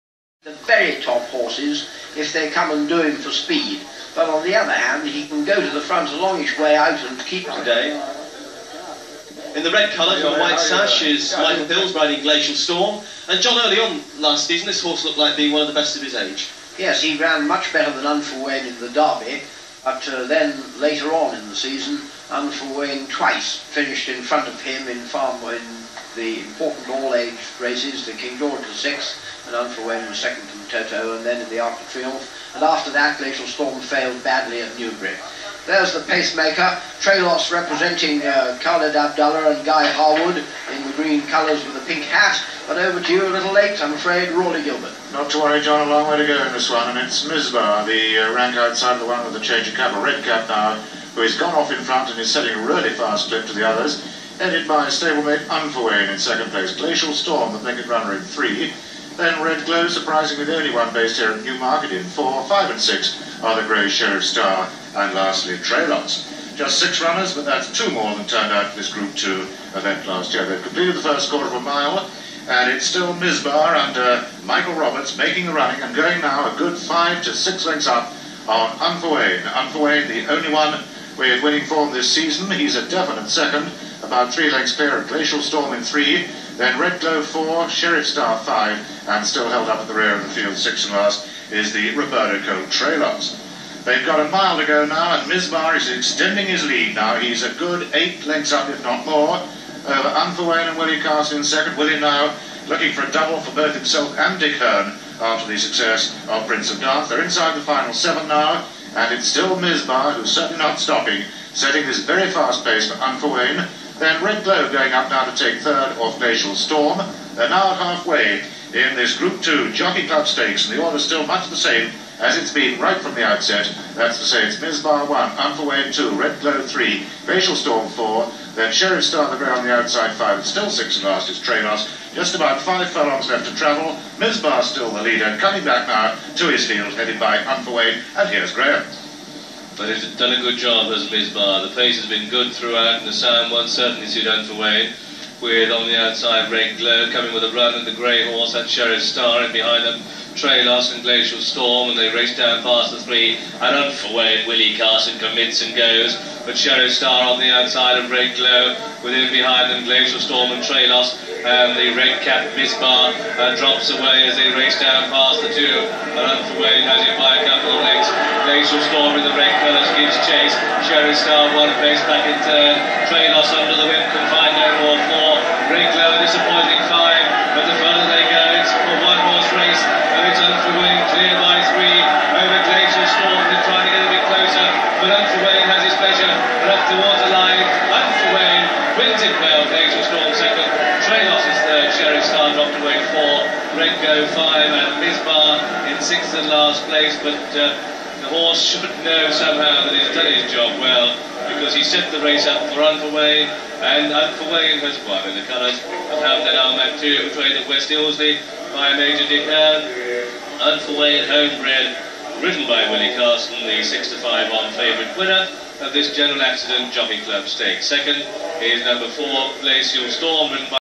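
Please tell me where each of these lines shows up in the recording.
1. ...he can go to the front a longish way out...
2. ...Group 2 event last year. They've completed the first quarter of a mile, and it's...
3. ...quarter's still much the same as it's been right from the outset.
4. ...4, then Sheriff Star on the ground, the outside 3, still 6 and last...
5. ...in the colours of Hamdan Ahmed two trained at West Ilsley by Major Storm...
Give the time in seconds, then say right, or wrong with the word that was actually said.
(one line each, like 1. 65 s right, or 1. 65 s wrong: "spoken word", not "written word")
1. 5 s right
2. 68 s right
3. 120 s wrong: "order", not "quarter"
4. 127 s wrong: "5", not "3"
5. 205 s wrong: "Dick", not "Storm".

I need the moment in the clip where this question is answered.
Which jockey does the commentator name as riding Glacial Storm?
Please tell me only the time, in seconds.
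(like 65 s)
11 s.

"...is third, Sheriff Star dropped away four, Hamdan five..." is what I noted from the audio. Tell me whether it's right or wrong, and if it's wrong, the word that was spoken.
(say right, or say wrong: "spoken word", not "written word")
wrong: "Renko", not "Hamdan".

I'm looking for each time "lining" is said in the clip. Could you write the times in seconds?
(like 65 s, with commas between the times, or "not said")
not said.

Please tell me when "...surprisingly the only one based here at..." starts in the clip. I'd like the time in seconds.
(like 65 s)
59 s.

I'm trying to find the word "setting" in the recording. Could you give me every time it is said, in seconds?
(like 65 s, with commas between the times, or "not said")
52 s, 111 s.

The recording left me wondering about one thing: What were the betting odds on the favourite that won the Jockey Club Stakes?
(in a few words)
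6-5 on.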